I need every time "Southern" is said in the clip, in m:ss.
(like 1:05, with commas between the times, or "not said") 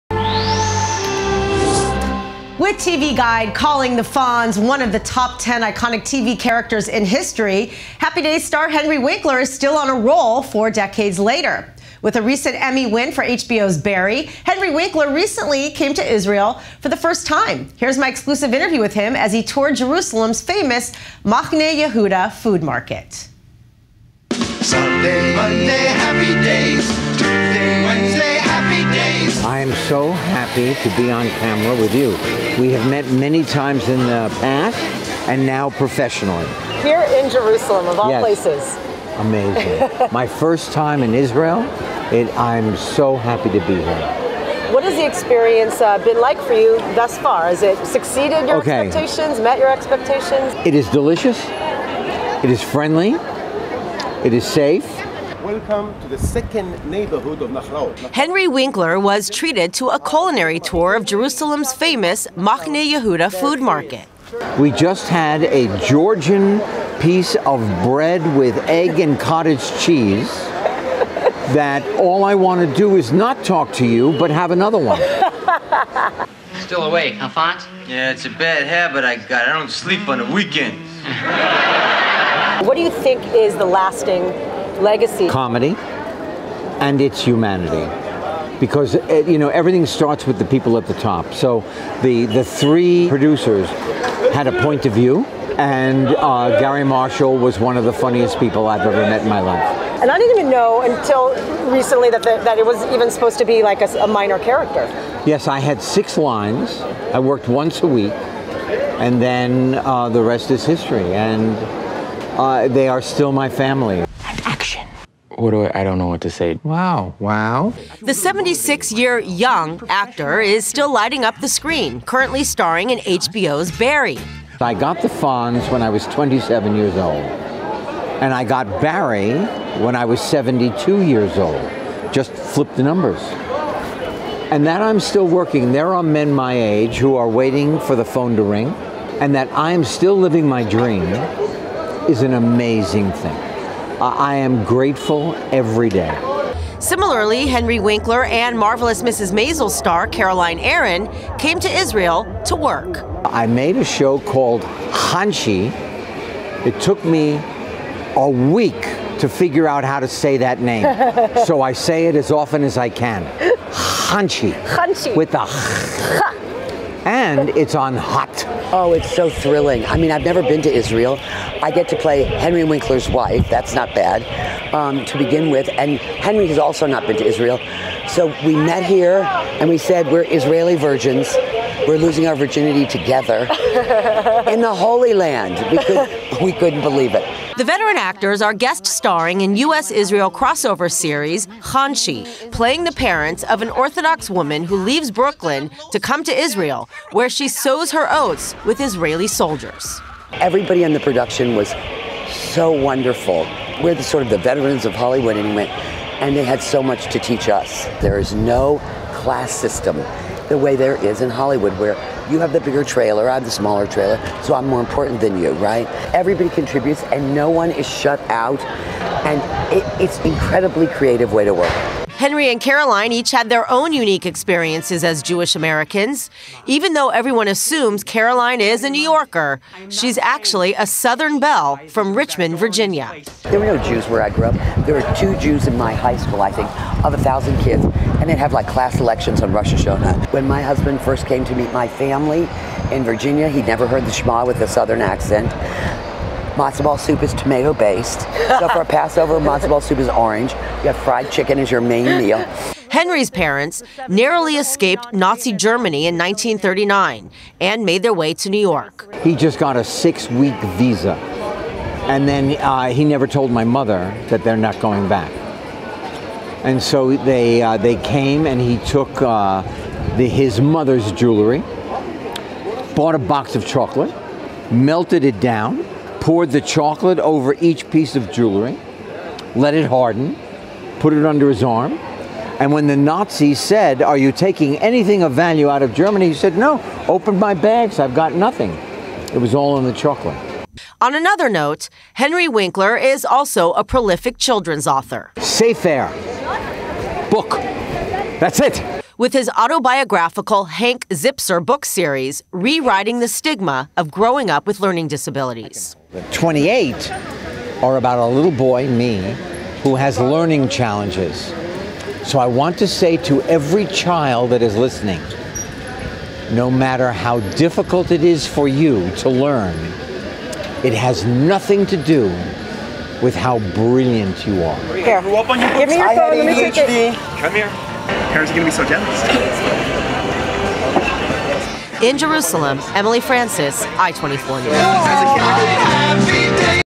3:50, 4:04.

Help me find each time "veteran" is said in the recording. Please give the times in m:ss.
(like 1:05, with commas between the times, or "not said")
3:07, 3:24.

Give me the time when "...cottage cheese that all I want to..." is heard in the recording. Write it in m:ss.
1:09.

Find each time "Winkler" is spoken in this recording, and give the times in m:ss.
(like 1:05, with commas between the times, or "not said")
0:08, 0:14, 0:58, 2:27, 2:52, 4:52.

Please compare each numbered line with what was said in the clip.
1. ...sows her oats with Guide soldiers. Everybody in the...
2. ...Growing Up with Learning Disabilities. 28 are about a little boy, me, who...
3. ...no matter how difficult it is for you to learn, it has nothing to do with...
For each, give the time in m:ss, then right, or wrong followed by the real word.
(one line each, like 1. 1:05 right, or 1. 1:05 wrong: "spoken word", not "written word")
1. 3:17 wrong: "Israeli", not "Guide"
2. 5:04 right
3. 5:16 right.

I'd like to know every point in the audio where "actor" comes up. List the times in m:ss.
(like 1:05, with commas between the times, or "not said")
1:59, 3:07.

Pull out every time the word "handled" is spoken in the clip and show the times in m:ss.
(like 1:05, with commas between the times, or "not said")
not said.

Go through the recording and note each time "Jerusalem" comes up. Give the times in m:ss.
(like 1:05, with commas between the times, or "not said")
0:19, 0:37, 1:01, 5:32.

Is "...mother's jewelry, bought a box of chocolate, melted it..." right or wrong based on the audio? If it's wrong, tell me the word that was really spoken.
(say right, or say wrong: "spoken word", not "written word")
right.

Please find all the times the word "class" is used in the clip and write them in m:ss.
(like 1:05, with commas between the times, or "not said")
3:29, 3:58.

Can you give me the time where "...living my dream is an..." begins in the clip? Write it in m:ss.
2:20.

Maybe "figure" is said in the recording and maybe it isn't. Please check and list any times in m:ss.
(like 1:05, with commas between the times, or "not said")
2:39.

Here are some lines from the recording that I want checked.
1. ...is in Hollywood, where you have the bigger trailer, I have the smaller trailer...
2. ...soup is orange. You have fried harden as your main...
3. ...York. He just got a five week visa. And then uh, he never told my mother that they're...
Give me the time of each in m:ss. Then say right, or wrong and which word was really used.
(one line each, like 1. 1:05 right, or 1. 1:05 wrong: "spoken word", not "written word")
1. 3:31 right
2. 4:09 wrong: "chicken", not "harden"
3. 4:18 wrong: "six", not "five".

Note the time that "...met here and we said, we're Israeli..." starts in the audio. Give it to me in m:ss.
2:58.